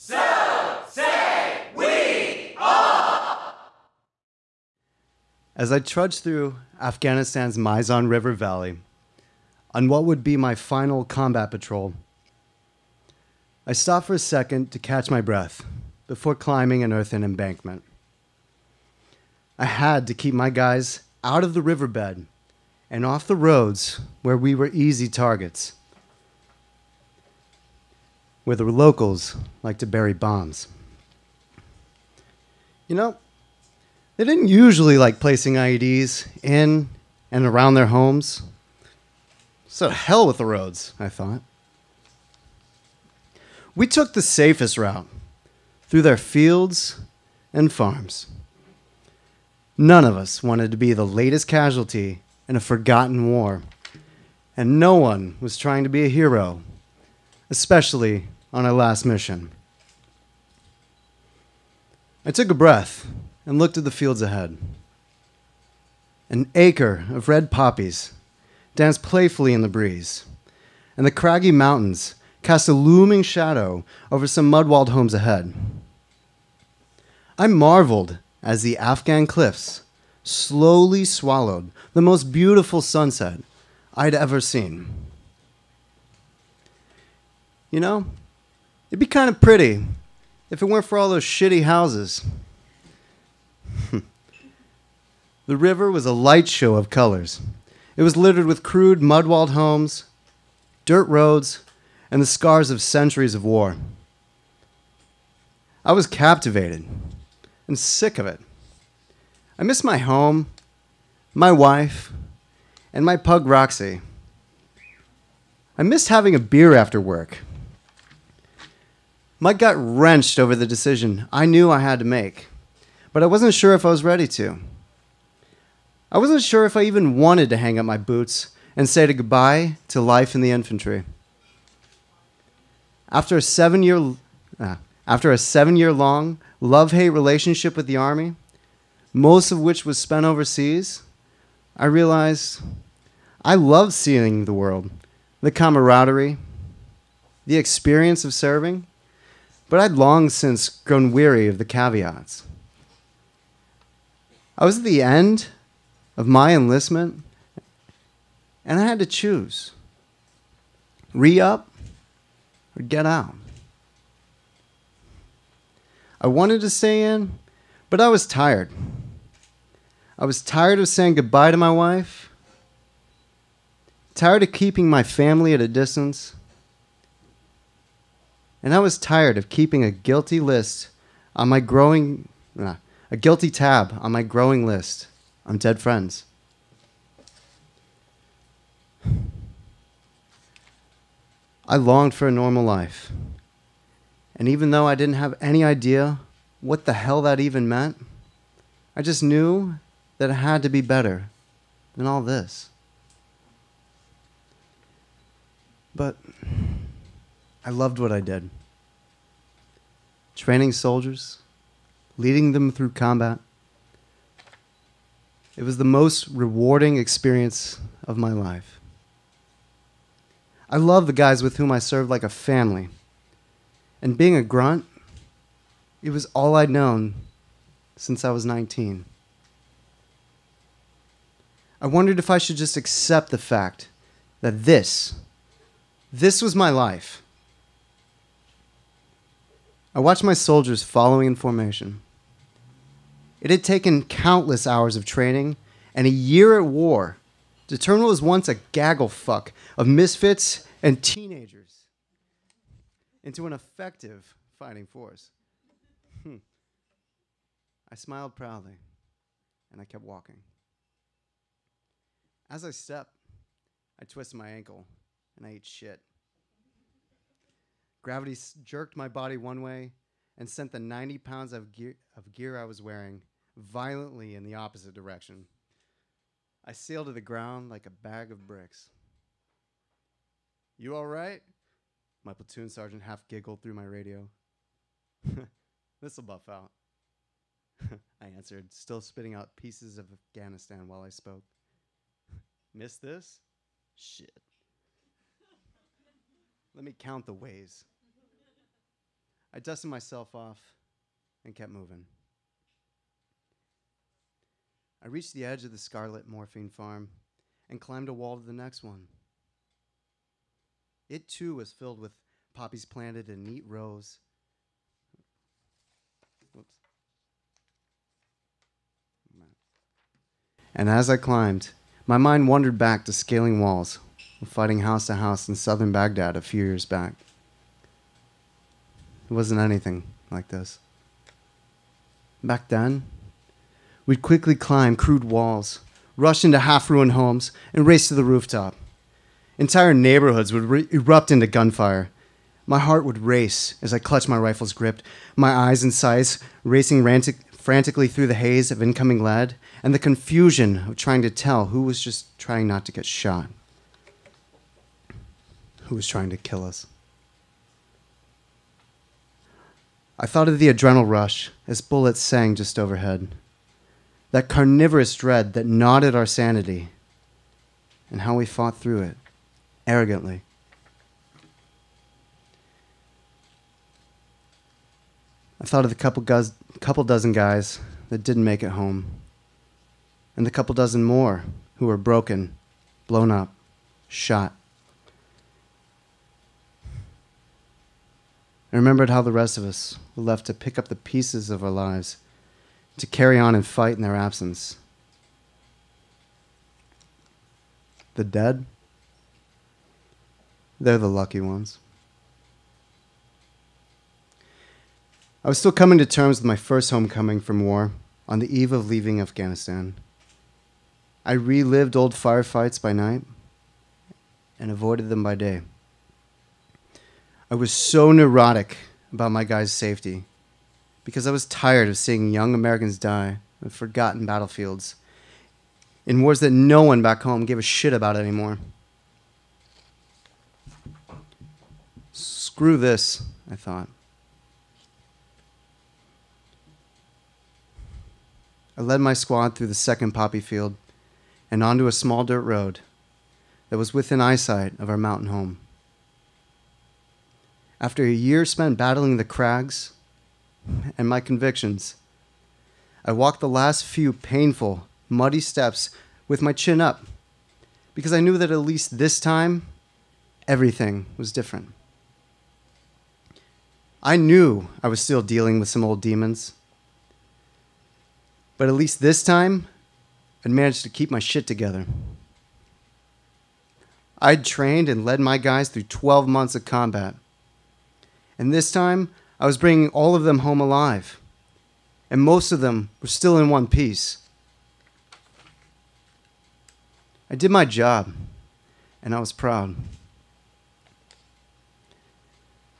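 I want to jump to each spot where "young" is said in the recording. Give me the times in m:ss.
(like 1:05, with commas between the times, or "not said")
7:02.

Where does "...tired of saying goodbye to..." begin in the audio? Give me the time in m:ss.
2:50.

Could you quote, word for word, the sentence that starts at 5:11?
It too was filled with poppies planted in neat rows.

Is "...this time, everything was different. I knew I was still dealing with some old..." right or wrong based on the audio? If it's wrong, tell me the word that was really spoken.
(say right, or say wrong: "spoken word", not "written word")
right.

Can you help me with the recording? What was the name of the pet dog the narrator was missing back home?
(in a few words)
Roxy.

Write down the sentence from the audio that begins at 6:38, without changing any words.
The dead, they're the lucky ones.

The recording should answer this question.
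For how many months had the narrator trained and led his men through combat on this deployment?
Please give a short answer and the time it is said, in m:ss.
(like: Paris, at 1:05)
12 months, at 7:55.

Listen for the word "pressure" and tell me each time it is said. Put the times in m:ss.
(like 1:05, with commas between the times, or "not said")
not said.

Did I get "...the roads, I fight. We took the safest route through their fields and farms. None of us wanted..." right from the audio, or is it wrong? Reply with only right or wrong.
wrong.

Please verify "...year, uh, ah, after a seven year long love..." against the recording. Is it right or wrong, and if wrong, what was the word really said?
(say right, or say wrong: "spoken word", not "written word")
right.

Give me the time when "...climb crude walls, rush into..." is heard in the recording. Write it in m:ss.
5:34.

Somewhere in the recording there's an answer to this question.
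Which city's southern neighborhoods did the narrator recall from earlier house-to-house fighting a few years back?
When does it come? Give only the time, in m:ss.
5:25.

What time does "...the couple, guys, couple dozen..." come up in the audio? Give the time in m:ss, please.
6:15.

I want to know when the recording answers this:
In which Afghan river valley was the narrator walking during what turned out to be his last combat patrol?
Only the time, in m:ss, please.
0:07.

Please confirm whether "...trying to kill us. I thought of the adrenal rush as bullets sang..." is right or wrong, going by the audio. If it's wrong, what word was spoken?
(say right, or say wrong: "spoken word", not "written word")
right.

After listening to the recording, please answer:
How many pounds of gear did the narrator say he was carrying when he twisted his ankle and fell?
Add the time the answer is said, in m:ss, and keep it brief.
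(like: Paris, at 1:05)
90 pounds, at 4:30.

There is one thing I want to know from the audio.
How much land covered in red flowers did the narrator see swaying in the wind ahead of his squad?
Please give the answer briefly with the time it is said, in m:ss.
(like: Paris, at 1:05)
An acre, at 1:06.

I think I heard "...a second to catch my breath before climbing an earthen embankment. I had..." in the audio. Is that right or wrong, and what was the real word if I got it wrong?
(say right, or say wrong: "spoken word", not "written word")
right.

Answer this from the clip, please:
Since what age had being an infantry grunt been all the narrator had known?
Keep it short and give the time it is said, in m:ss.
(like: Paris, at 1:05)
Since 19, at 3:48.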